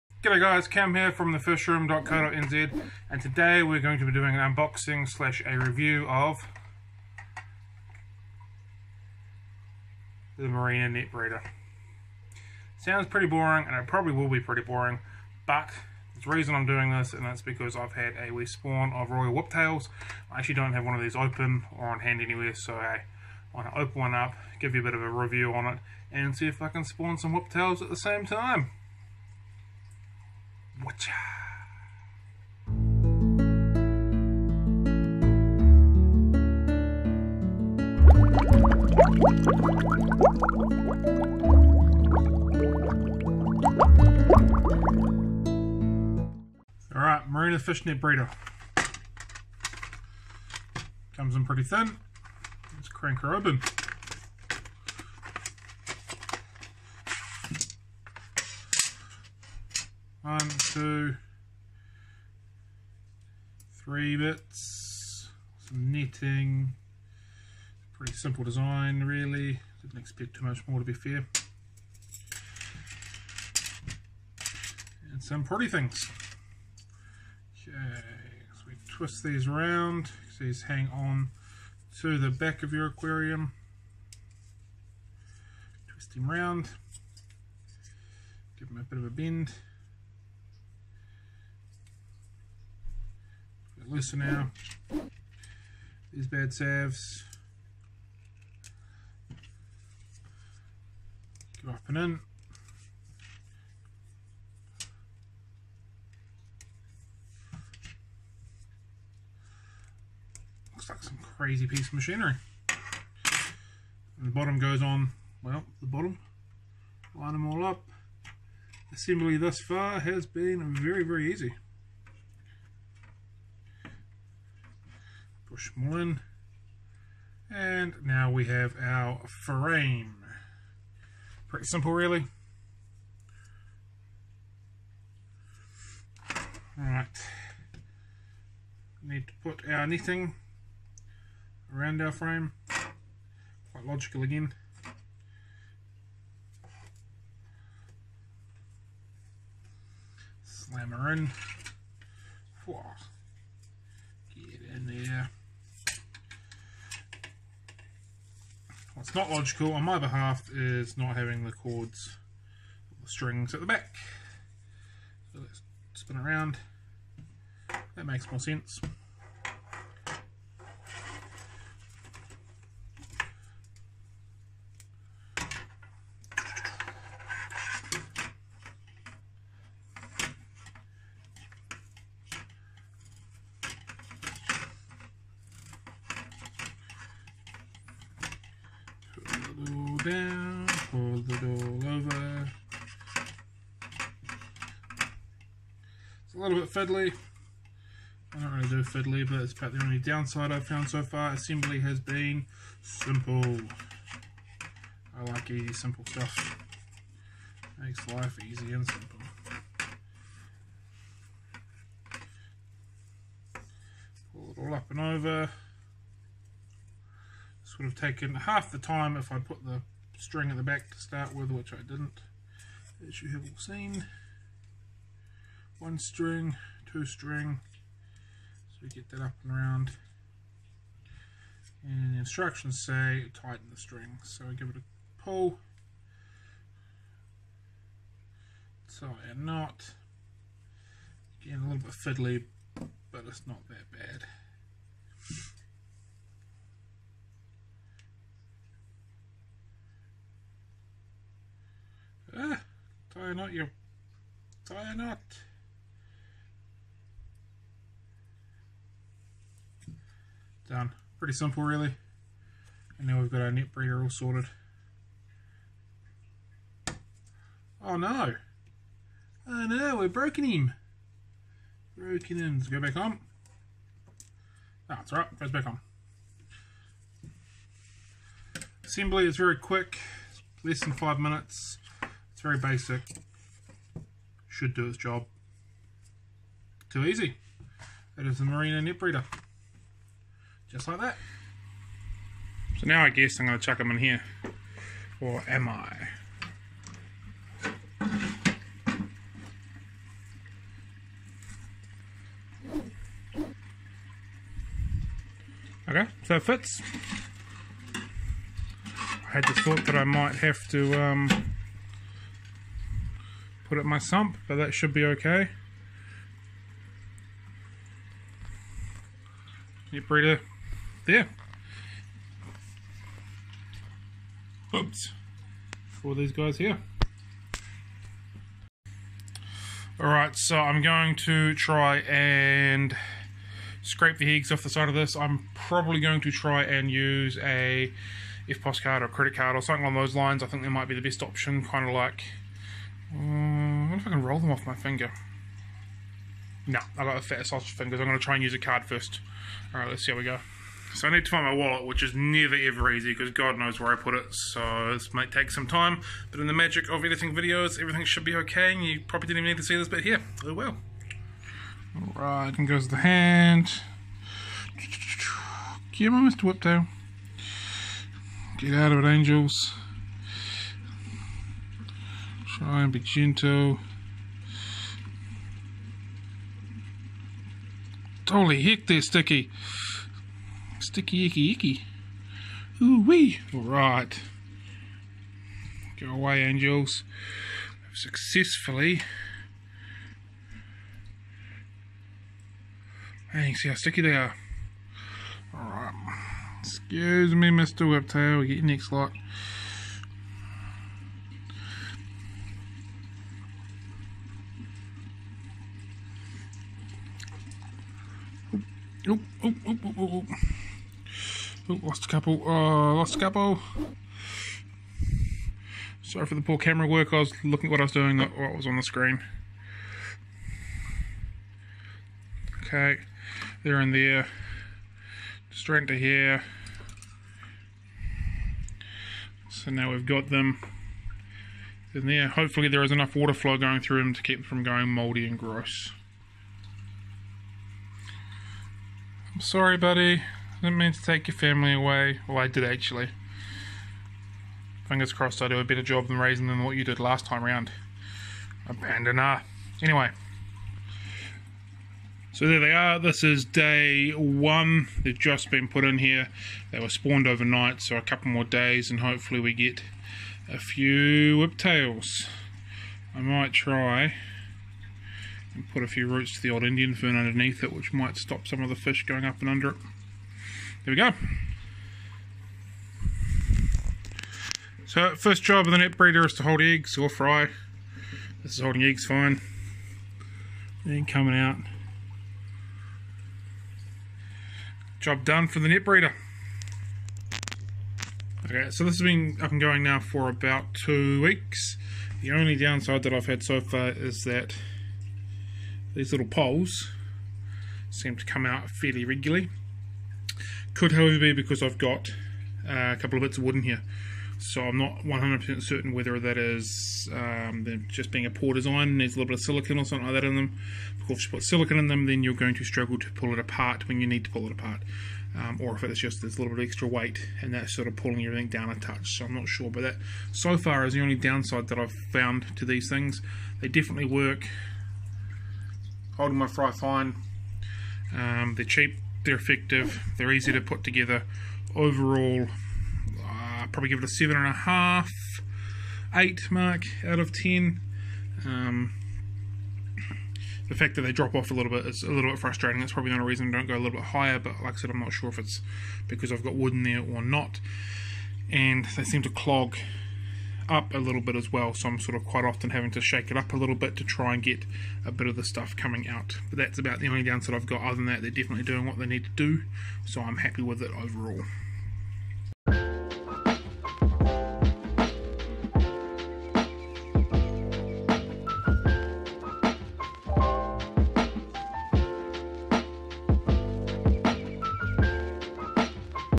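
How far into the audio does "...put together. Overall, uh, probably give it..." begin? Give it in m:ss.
8:50.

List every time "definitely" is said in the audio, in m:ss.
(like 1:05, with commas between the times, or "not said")
8:43, 9:18.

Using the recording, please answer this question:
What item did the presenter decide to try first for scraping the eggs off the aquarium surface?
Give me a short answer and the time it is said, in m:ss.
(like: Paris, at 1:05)
a card, at 5:48.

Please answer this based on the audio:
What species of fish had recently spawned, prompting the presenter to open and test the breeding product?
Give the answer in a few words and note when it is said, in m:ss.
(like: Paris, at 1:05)
Royal Whiptails, at 0:19.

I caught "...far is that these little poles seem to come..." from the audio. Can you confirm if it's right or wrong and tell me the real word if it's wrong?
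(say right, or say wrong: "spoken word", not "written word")
right.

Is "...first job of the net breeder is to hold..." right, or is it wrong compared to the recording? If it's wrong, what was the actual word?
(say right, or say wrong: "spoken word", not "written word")
right.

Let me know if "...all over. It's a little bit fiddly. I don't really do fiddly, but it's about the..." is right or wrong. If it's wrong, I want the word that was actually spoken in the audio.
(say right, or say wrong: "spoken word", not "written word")
right.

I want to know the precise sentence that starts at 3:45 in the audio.
One string, two string, so we get that up and around.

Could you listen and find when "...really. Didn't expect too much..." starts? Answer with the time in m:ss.
1:09.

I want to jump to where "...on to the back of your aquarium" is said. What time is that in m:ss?
1:20.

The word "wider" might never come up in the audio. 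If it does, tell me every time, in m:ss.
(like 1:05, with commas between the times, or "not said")
not said.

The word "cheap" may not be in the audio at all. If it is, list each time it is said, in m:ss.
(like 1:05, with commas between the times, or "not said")
8:48.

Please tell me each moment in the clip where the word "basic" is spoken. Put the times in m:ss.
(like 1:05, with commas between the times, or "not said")
4:42.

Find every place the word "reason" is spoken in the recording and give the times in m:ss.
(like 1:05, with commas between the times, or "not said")
0:16, 9:03.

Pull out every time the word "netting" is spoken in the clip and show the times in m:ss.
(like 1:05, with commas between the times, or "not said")
1:05, 2:19.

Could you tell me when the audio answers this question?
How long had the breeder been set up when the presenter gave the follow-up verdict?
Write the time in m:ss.
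8:10.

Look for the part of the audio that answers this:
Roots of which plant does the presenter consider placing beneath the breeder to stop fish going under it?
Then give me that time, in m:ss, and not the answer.
7:46.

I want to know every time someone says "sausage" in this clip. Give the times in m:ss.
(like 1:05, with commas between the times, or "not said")
5:47.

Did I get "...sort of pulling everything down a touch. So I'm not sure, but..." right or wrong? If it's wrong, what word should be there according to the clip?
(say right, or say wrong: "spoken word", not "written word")
right.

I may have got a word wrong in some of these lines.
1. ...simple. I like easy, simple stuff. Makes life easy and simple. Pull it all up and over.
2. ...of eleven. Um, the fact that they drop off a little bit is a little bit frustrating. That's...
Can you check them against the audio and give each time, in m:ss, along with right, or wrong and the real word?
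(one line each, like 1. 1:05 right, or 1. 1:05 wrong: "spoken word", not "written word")
1. 3:22 right
2. 8:57 wrong: "ten", not "eleven".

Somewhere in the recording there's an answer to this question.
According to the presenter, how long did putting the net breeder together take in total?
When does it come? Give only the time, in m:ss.
4:40.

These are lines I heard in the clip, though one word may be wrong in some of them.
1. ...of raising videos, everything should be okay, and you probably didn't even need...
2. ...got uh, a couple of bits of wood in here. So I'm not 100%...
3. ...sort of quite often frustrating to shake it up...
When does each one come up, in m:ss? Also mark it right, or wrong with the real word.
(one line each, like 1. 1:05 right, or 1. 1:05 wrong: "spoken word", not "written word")
1. 5:56 wrong: "editing", not "raising"
2. 8:21 right
3. 9:11 wrong: "having", not "frustrating".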